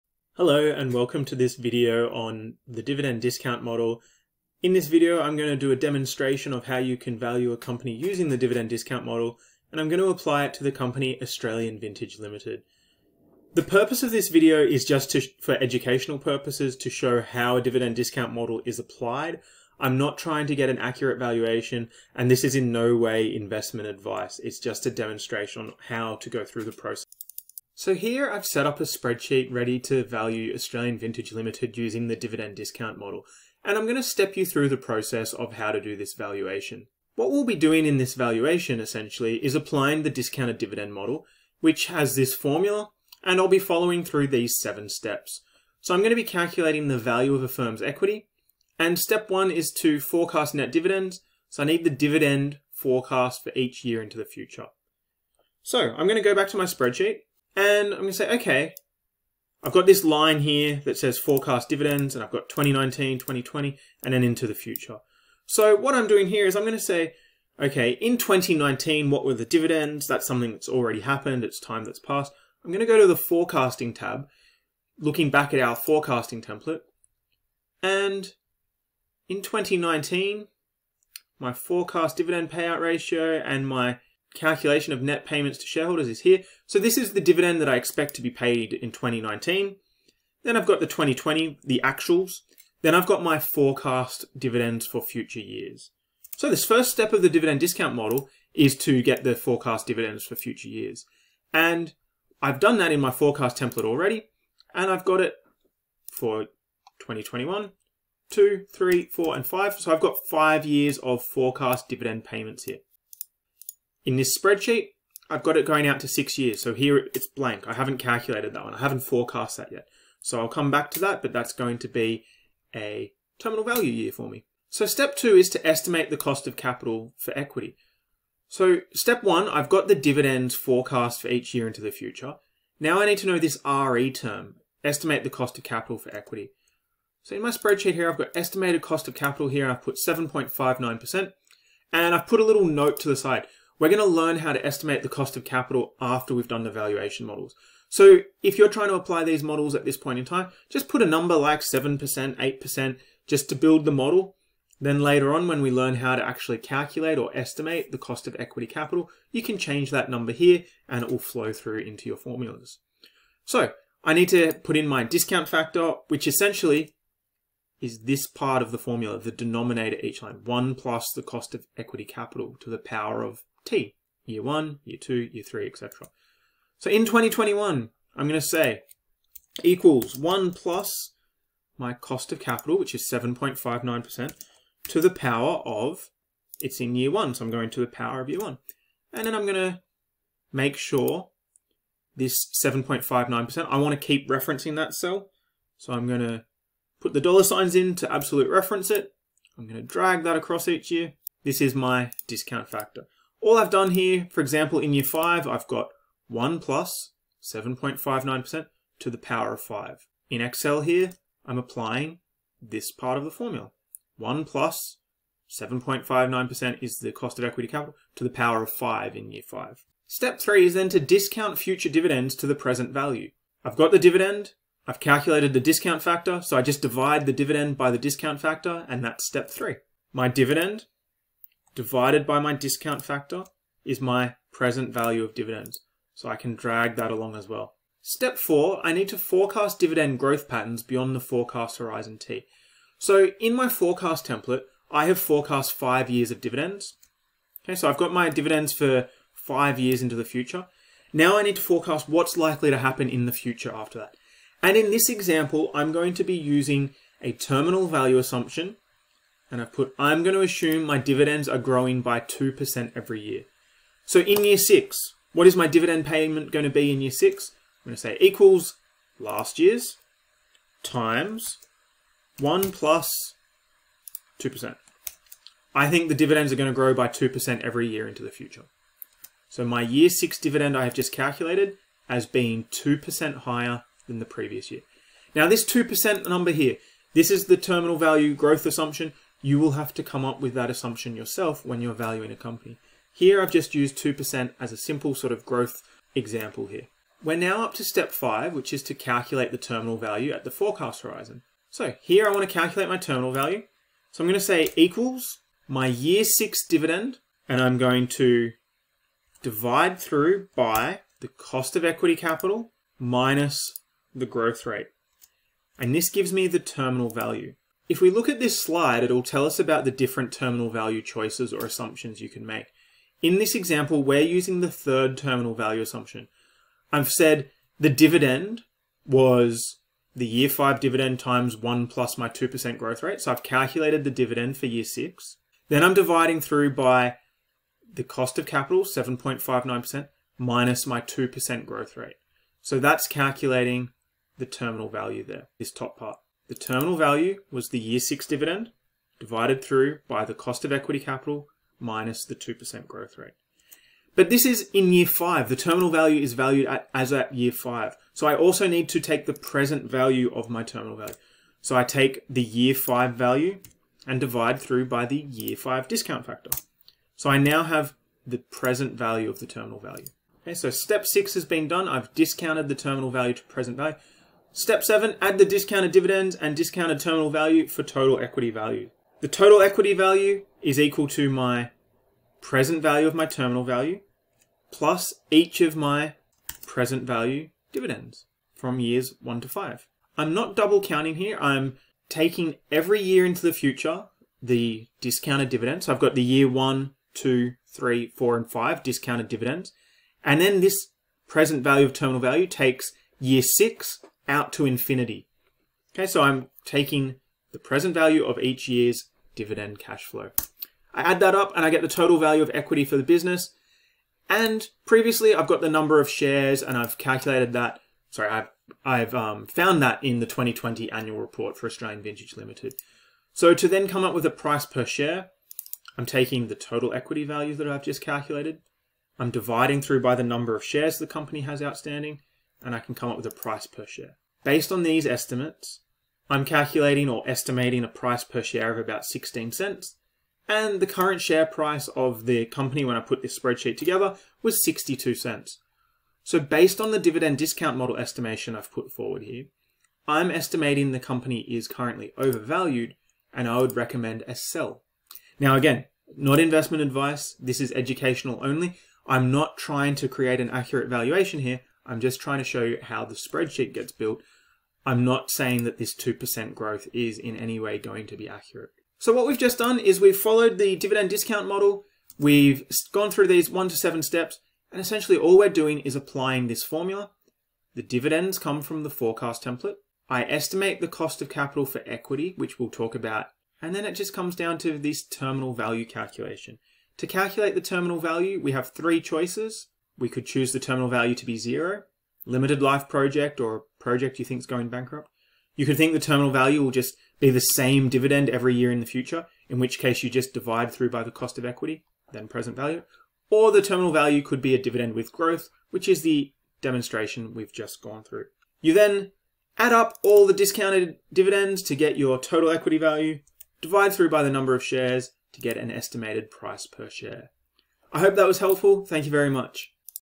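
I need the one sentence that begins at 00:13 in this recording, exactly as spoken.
The purpose of this video is just to, for educational purposes to show how a dividend discount model is applied.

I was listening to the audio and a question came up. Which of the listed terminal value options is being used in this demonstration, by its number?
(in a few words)
third.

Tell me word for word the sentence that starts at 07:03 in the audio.
So to then come up with a price per share, I'm taking the total equity value that I've just calculated.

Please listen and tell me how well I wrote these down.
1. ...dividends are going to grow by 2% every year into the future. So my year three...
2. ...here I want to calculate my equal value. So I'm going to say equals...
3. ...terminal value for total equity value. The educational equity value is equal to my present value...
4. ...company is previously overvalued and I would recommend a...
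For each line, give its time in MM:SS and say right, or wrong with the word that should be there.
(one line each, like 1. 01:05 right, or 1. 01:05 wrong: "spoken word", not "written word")
1. 04:36 wrong: "six", not "three"
2. 05:02 wrong: "terminal", not "equal"
3. 06:16 wrong: "total", not "educational"
4. 07:30 wrong: "currently", not "previously".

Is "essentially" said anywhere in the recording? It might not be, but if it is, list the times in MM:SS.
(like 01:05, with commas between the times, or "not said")
00:38, 02:46, 07:54.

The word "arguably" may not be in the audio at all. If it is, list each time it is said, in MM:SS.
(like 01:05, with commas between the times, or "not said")
not said.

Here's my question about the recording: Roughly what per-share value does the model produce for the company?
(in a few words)
16 cents.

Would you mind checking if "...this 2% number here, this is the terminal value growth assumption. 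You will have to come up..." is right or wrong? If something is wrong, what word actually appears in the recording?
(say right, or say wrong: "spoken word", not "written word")
right.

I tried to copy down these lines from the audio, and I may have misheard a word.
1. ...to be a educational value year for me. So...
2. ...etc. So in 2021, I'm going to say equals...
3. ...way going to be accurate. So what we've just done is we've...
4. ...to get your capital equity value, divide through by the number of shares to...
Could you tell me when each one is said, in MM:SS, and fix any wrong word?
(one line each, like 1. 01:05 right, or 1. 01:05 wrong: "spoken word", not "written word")
1. 02:01 wrong: "terminal", not "educational"
2. 02:55 right
3. 07:47 right
4. 08:31 wrong: "total", not "capital".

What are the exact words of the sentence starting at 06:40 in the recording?
And then this present value of terminal value takes year 6 out to infinity.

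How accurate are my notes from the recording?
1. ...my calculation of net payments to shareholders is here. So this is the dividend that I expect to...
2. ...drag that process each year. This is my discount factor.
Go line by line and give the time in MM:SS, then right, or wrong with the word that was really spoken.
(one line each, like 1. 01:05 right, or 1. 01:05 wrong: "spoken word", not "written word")
1. 01:23 right
2. 03:19 wrong: "across", not "process".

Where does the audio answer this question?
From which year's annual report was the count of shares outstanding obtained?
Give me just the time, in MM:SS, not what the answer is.
07:00.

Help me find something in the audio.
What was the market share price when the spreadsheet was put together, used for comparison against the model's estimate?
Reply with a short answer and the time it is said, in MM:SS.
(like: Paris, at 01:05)
62 cents, at 07:24.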